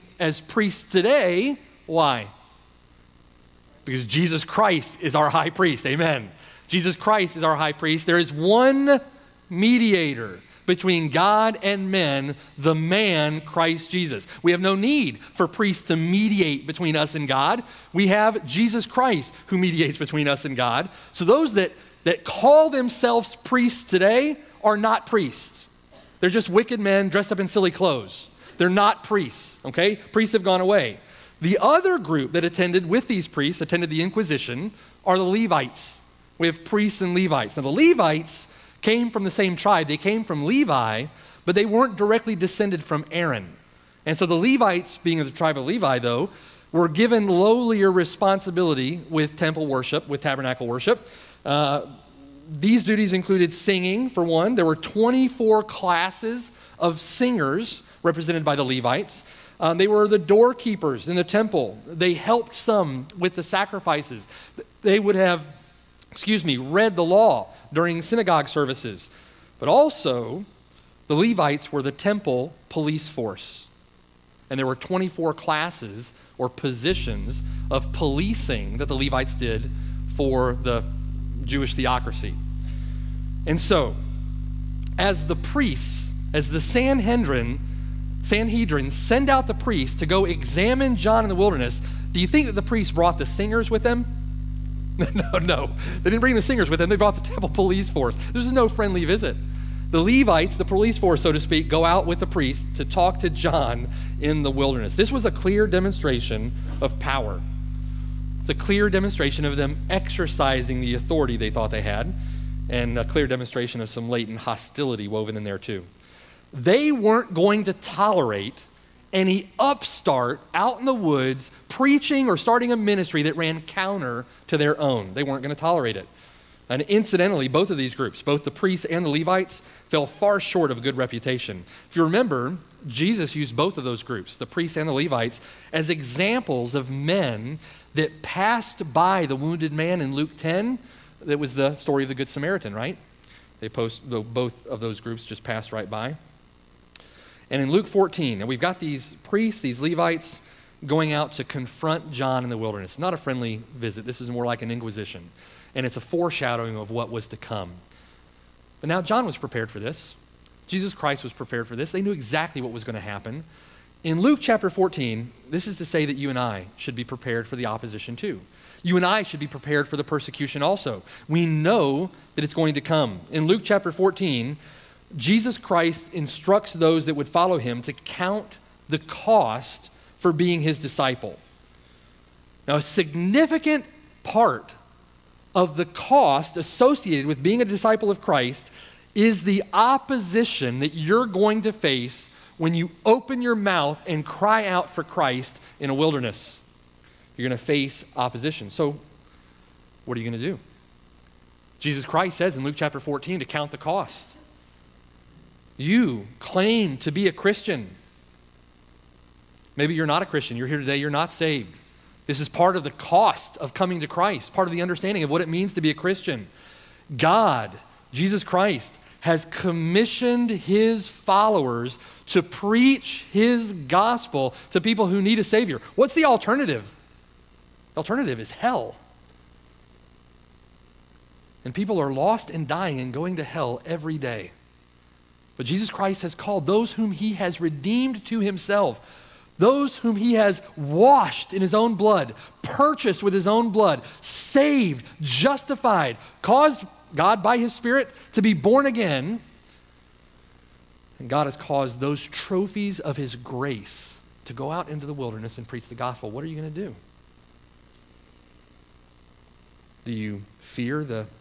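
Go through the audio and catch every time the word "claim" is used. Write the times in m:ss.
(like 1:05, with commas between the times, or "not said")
3:26.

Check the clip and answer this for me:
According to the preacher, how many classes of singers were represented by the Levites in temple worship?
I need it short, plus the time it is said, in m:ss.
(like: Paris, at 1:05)
24, at 0:54.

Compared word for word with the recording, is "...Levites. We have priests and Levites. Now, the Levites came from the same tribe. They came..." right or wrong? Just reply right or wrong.
right.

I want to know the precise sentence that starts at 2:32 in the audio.
not a friendly visit, this is more like an inquisition.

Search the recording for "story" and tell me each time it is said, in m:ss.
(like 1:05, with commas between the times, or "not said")
2:21.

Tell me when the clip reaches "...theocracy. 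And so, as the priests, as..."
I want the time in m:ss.
1:21.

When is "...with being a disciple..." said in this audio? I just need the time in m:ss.
3:07.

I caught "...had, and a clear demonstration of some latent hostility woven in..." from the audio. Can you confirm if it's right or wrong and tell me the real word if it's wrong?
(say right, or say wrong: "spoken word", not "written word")
right.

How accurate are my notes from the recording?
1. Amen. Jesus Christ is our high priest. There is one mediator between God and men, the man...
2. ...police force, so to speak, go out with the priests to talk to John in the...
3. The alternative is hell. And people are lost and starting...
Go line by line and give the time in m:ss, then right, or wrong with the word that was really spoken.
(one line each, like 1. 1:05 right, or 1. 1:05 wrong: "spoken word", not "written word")
1. 0:05 right
2. 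1:40 right
3. 3:47 wrong: "dying", not "starting".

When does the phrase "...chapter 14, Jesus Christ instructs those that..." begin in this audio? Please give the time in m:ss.
2:53.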